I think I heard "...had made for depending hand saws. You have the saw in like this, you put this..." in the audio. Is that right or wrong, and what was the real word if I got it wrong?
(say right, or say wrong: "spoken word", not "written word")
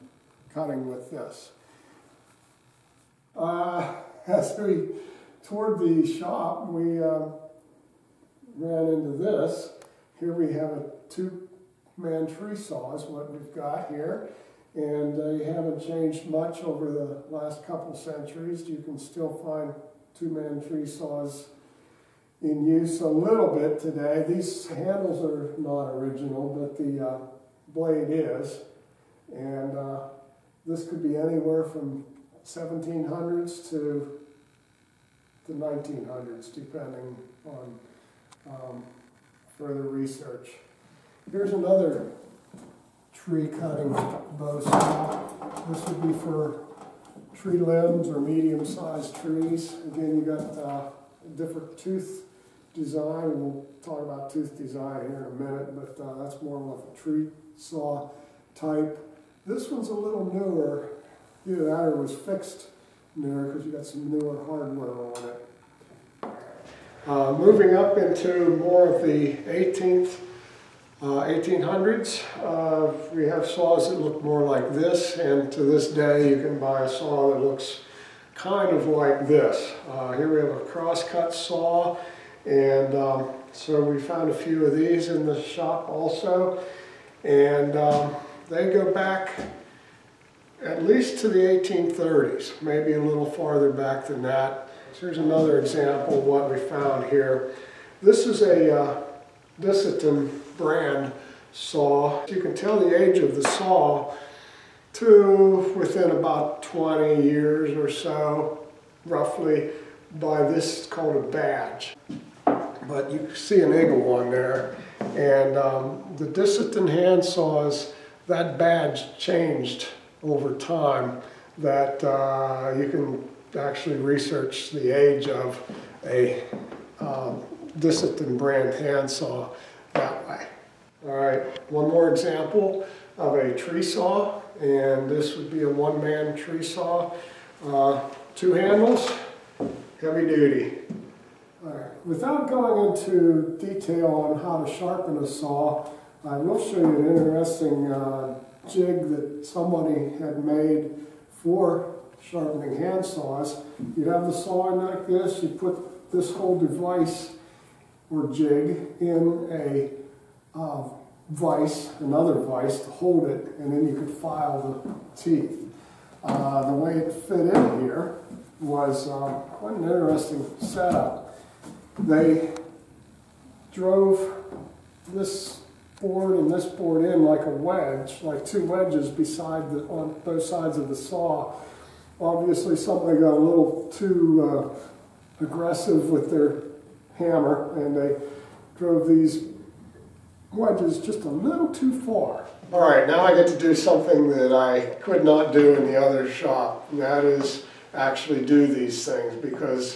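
wrong: "sharpening", not "depending".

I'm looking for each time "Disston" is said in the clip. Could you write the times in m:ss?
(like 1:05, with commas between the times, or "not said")
1:39, 1:56.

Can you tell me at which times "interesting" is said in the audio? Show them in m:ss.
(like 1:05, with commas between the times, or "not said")
2:27, 2:49.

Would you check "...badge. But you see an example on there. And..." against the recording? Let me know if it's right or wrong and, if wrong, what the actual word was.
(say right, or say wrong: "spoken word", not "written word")
wrong: "eagle", not "example".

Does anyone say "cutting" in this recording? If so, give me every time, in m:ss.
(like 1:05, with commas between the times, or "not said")
0:00, 0:43.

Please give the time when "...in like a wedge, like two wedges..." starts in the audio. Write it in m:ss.
2:57.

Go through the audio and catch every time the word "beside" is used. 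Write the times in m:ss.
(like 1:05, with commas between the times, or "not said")
2:59.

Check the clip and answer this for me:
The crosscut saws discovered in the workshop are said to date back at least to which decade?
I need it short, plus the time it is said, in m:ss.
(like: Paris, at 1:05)
1830s, at 1:31.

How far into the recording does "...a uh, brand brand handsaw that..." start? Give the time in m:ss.
2:06.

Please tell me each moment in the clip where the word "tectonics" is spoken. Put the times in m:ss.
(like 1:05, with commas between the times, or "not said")
not said.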